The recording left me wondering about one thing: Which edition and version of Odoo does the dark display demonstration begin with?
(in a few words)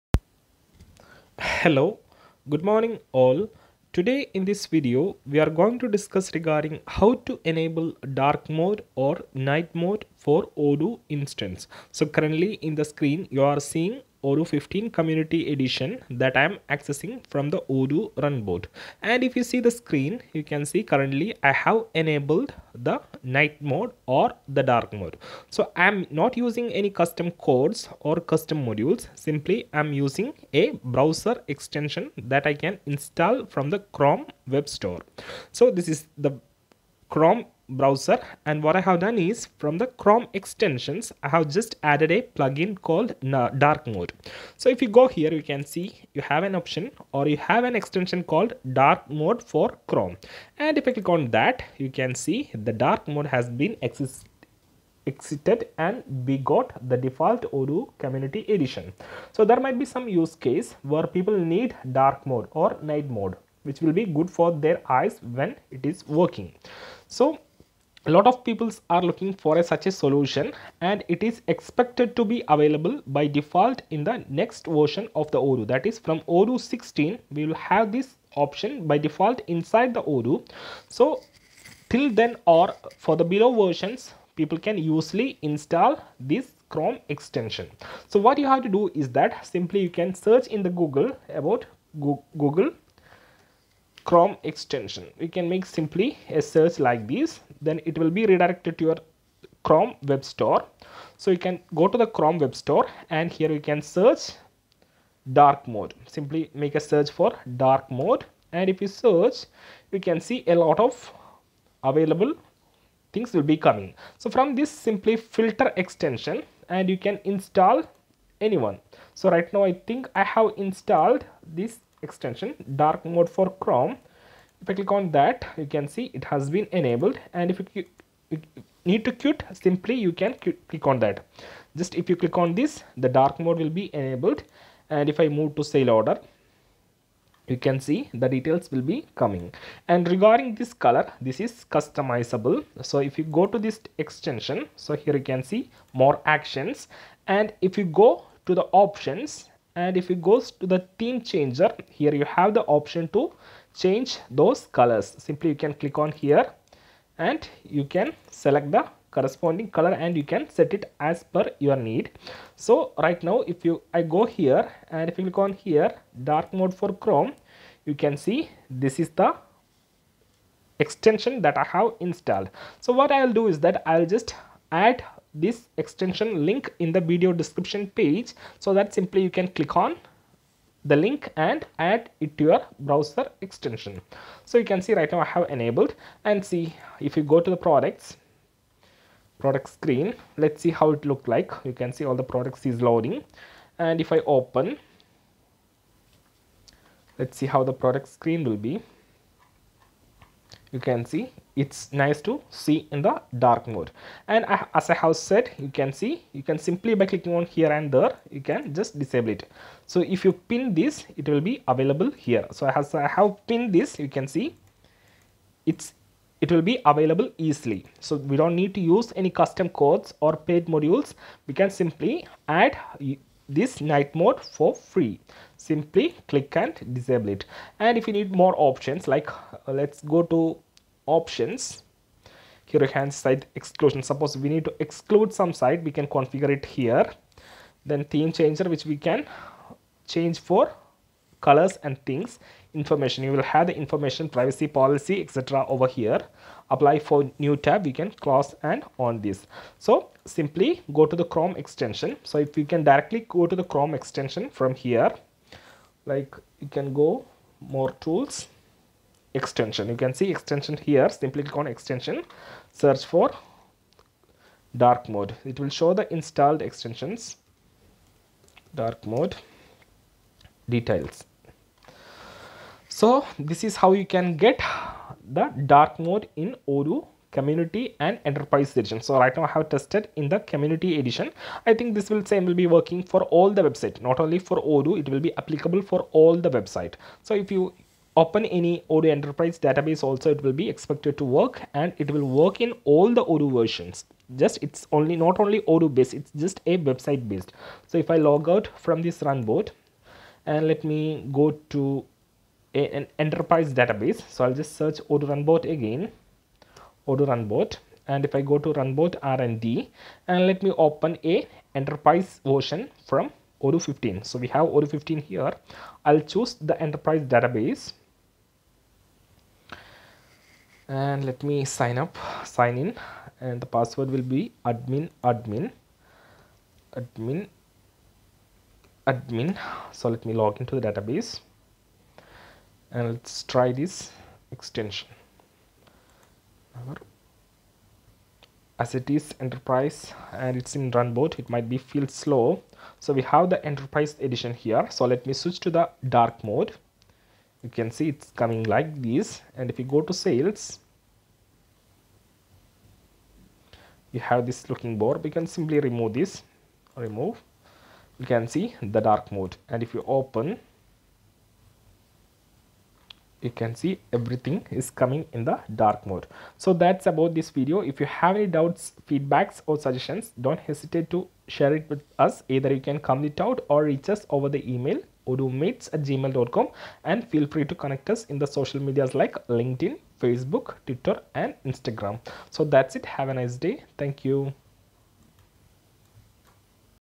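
Odoo 15 community edition.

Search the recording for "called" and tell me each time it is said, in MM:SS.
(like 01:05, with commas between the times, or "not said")
00:42, 00:48.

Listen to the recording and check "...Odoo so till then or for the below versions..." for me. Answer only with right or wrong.
right.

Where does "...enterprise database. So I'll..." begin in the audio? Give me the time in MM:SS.
05:03.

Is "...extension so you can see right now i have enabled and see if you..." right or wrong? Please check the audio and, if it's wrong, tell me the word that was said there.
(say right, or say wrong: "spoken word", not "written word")
right.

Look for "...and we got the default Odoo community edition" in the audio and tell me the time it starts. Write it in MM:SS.
00:55.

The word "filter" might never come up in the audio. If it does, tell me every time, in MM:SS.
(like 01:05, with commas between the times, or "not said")
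01:55.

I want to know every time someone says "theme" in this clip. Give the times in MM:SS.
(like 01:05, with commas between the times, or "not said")
02:30, 03:58.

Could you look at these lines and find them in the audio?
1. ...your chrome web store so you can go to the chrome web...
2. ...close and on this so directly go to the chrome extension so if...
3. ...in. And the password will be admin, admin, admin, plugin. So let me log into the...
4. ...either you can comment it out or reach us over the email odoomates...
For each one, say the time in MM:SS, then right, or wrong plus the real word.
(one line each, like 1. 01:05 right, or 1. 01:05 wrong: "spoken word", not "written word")
1. 01:38 right
2. 04:08 wrong: "simply", not "directly"
3. 05:22 wrong: "admin", not "plugin"
4. 06:12 right.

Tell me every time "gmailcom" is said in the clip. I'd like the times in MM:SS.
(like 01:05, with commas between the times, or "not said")
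06:16.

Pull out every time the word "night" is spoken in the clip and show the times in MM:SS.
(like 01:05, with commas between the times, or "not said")
00:09, 00:23, 01:02, 03:43.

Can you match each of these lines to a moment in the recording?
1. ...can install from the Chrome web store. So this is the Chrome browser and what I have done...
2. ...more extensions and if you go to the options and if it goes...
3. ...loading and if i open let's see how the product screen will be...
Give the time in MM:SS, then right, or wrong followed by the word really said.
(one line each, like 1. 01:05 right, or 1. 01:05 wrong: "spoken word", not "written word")
1. 00:32 right
2. 02:25 wrong: "actions", not "extensions"
3. 03:12 right.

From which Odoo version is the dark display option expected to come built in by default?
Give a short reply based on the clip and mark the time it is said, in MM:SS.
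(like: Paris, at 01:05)
Odoo 16, at 01:16.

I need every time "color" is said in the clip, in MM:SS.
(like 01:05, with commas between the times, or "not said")
02:20, 02:34, 02:39, 04:01.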